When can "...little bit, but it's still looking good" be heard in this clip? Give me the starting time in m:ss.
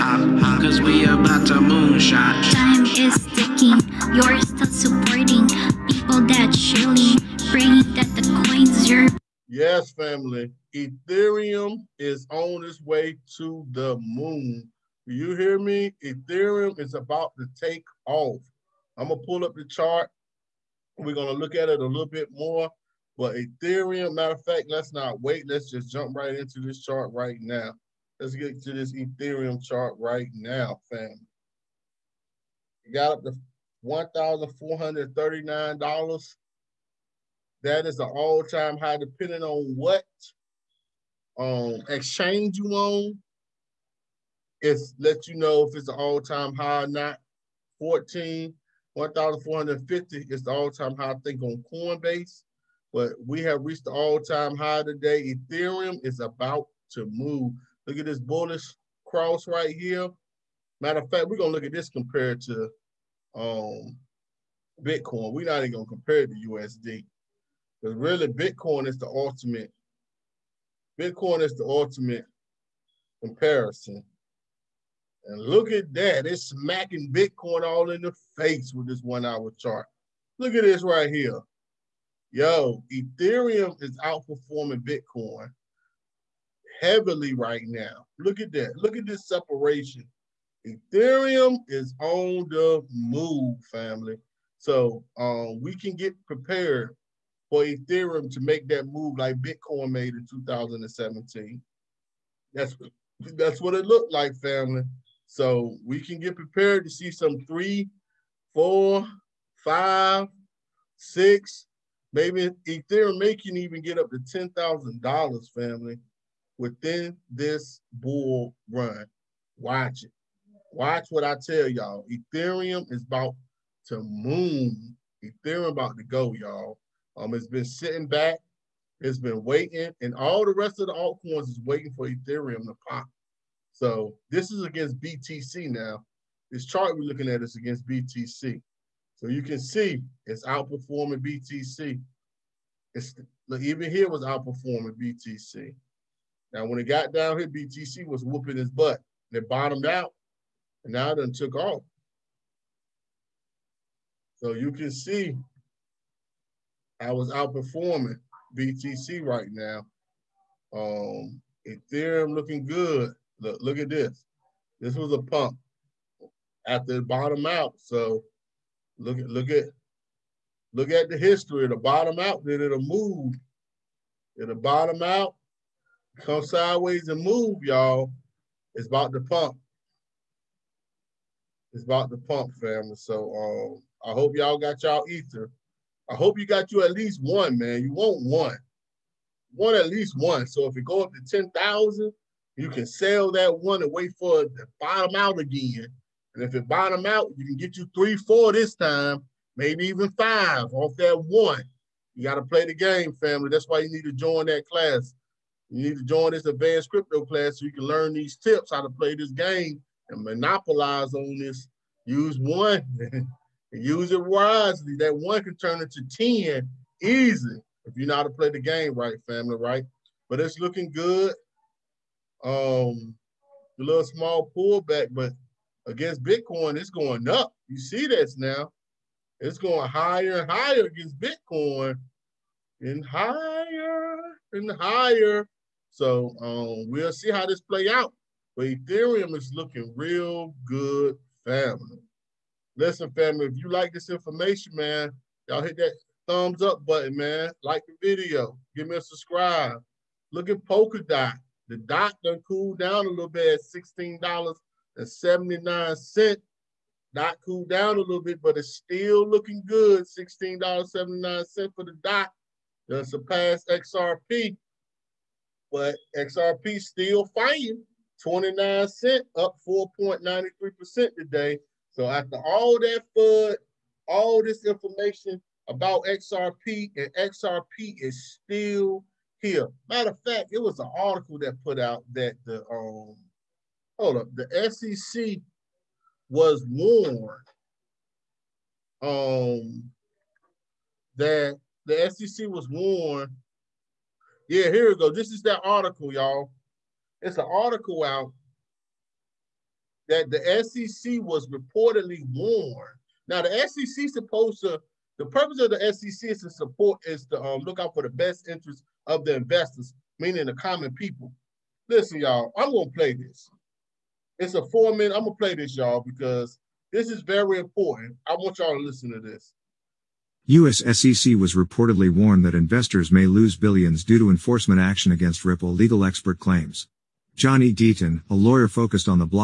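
4:17.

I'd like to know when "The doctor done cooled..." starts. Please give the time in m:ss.
4:11.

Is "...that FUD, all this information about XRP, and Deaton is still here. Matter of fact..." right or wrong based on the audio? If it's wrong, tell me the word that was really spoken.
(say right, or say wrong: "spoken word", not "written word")
wrong: "XRP", not "Deaton".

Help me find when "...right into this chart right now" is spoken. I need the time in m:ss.
0:26.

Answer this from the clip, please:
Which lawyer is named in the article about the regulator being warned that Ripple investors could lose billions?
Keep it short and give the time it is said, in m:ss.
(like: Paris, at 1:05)
Johnny Deaton, at 5:27.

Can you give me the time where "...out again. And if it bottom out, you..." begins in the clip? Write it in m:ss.
3:15.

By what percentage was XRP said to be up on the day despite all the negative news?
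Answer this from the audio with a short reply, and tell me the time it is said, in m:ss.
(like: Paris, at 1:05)
4.93%, at 4:29.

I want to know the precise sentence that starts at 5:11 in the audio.
Listen, y'all, I'm gonna play this.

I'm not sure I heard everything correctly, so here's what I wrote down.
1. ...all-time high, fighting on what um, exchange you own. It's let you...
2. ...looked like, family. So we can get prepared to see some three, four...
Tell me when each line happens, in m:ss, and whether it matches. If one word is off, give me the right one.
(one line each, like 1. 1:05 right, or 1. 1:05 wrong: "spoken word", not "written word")
1. 0:38 wrong: "depending", not "fighting"
2. 1:43 right.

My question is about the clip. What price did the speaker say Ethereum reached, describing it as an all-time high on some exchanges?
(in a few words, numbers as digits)
$1,439.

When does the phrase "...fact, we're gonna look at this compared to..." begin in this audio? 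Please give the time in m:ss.
1:01.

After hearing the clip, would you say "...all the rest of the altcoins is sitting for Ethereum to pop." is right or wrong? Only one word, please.
wrong.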